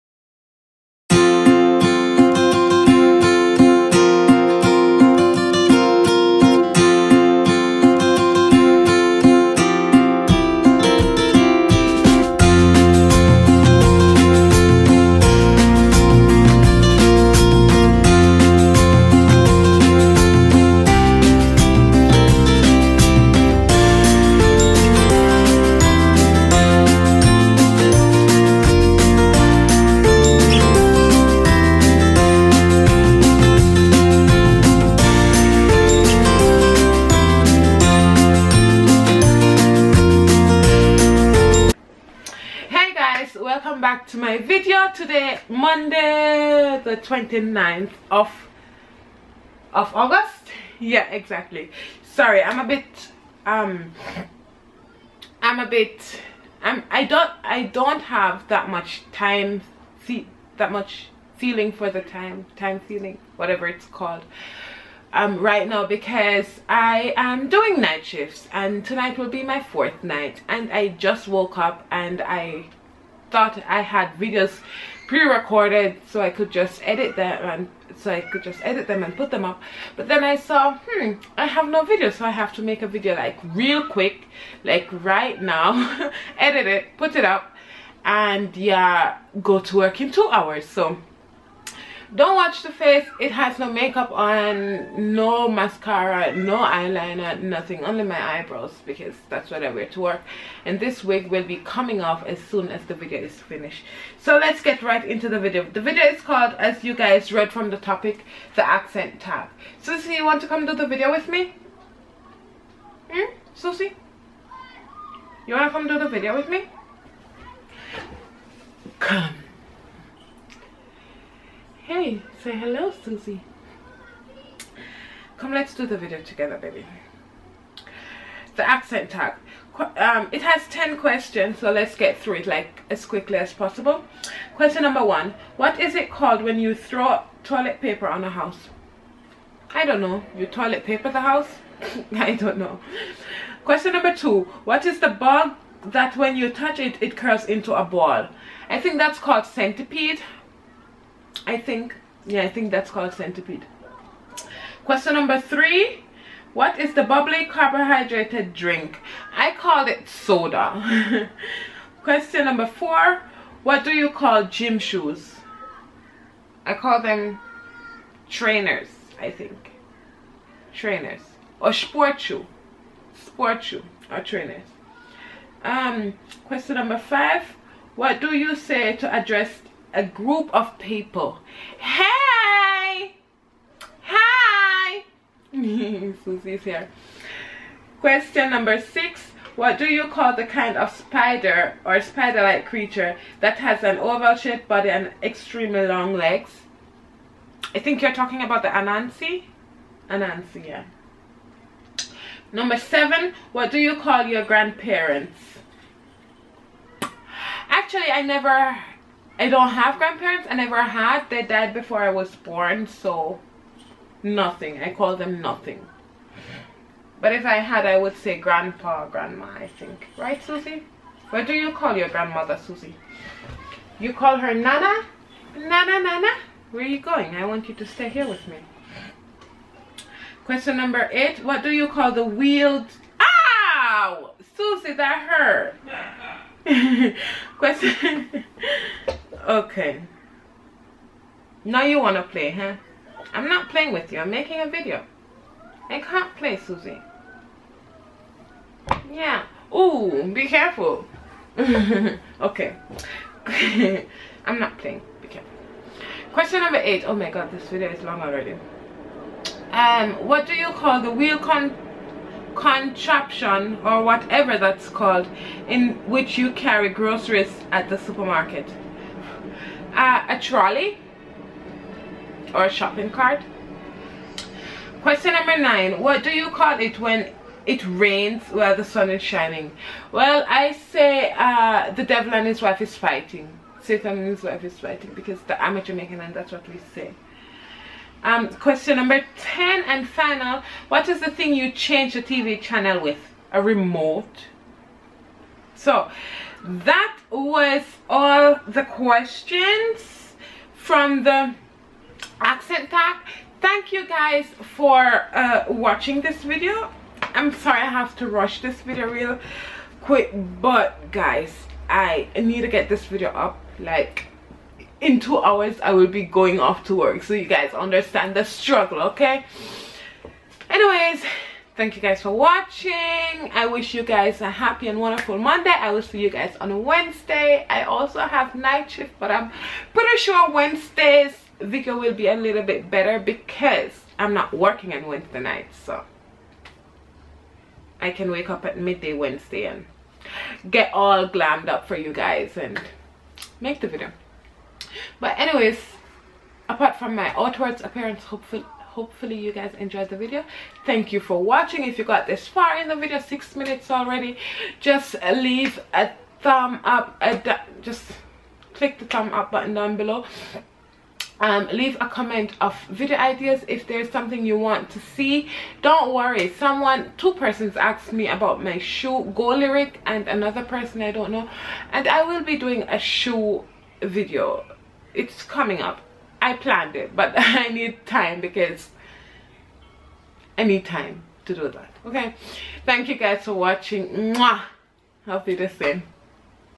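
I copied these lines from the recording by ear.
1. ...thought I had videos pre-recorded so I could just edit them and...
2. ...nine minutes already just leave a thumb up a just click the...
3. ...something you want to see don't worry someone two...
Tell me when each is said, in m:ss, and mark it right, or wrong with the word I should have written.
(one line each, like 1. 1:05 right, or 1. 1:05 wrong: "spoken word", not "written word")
1. 1:13 right
2. 5:53 wrong: "six", not "nine"
3. 6:04 right.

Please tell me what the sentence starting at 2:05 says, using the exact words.
Come, let's do the video together, baby.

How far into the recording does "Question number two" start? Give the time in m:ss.
2:23.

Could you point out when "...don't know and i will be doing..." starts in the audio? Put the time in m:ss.
6:11.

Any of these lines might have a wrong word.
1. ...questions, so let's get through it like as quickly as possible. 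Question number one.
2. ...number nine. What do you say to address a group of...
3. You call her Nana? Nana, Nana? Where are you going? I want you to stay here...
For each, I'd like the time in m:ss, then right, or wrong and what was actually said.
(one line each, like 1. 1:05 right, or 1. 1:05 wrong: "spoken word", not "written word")
1. 2:10 right
2. 2:56 wrong: "five", not "nine"
3. 3:43 right.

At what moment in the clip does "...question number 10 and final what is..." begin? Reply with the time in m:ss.
4:48.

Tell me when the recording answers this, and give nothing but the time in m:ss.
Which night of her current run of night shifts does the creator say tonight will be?
1:09.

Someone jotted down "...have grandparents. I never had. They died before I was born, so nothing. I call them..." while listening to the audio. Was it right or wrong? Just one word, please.
right.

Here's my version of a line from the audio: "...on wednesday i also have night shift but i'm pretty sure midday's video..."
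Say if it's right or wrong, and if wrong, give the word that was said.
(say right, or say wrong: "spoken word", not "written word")
wrong: "wednesday", not "midday".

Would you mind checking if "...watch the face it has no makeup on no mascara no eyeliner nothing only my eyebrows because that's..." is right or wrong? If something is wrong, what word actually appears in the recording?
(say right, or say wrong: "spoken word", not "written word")
right.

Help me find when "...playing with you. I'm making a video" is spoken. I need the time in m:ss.
4:03.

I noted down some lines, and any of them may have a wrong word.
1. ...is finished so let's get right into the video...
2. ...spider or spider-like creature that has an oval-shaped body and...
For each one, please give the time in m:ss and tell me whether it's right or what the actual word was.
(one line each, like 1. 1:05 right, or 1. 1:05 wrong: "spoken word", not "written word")
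1. 1:43 right
2. 3:10 right.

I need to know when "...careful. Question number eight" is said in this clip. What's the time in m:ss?
4:15.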